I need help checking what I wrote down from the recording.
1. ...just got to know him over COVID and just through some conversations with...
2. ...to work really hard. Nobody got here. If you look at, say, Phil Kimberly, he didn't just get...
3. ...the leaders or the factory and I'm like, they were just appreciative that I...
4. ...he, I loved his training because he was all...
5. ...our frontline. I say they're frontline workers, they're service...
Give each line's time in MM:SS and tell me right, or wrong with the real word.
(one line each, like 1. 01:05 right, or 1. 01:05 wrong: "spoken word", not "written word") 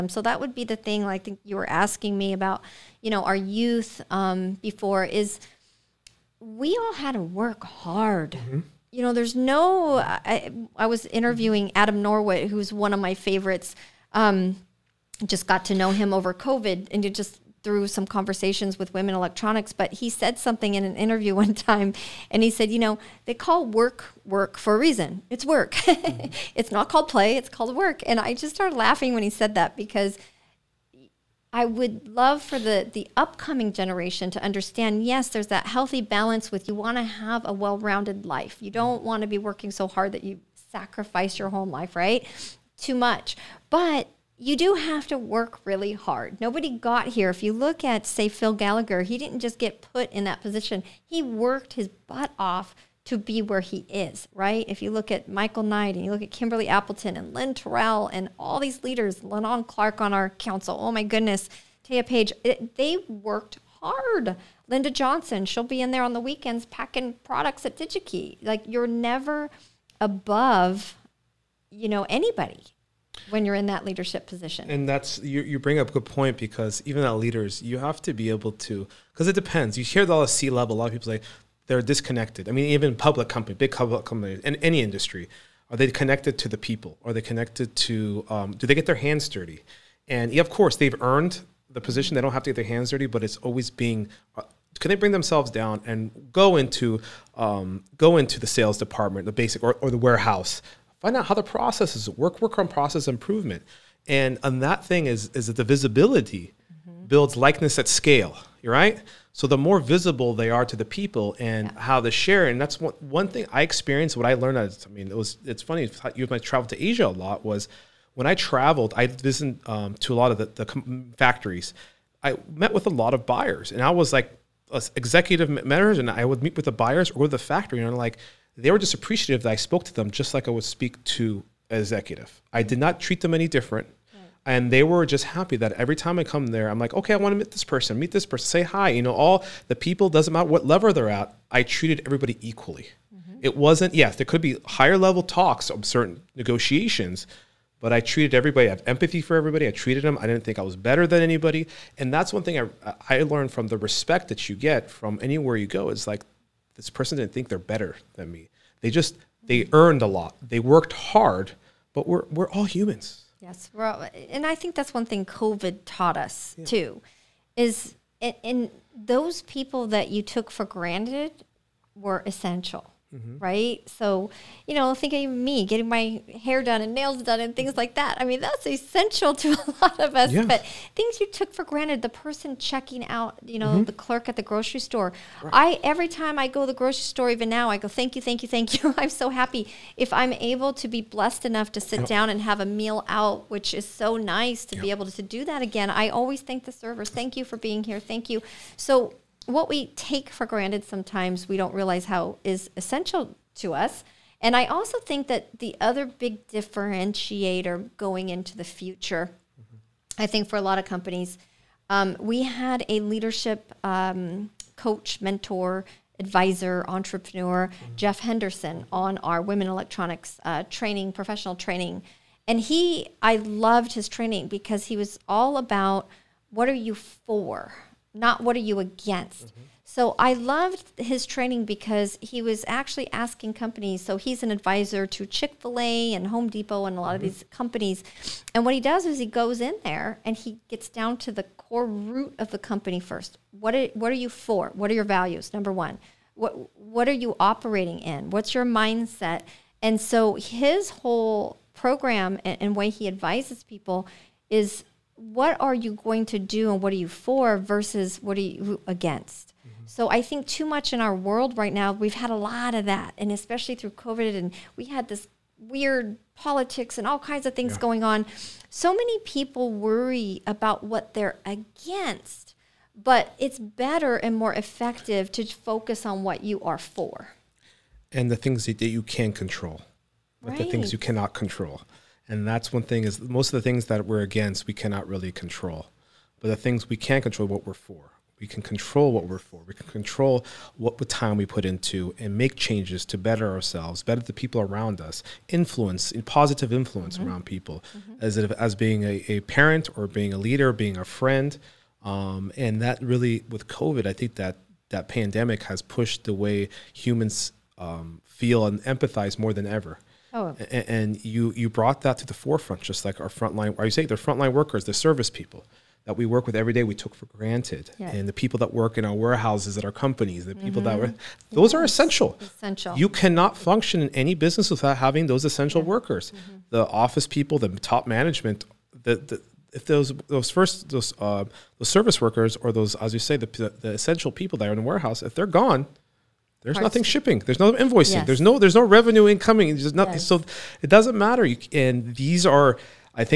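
1. 00:15 right
2. 00:45 wrong: "Gallagher", not "Kimberly"
3. 02:06 wrong: "buyers", not "leaders"
4. 03:42 right
5. 05:13 right.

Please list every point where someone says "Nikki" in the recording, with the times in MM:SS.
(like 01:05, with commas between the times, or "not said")
not said.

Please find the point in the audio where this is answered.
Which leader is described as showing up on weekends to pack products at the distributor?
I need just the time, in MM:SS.
01:04.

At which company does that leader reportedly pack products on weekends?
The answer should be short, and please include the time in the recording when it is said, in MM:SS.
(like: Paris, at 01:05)
DigiKey, at 01:07.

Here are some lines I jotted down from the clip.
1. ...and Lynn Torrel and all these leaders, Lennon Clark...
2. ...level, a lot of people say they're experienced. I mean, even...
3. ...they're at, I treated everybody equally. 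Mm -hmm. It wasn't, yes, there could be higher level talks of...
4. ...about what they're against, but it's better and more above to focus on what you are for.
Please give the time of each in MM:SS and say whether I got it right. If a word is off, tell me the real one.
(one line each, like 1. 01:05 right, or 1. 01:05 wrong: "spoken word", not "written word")
1. 00:57 right
2. 01:20 wrong: "disconnected", not "experienced"
3. 02:20 right
4. 04:30 wrong: "effective", not "above".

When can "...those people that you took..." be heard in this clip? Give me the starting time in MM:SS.
02:48.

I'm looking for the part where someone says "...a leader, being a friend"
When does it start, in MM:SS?
05:00.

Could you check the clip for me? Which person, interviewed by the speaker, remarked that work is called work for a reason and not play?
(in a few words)
Adam Norwood.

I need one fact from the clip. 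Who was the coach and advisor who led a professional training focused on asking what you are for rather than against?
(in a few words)
Jeff Henderson.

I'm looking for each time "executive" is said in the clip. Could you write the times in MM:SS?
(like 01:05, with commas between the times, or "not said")
02:04, 02:11.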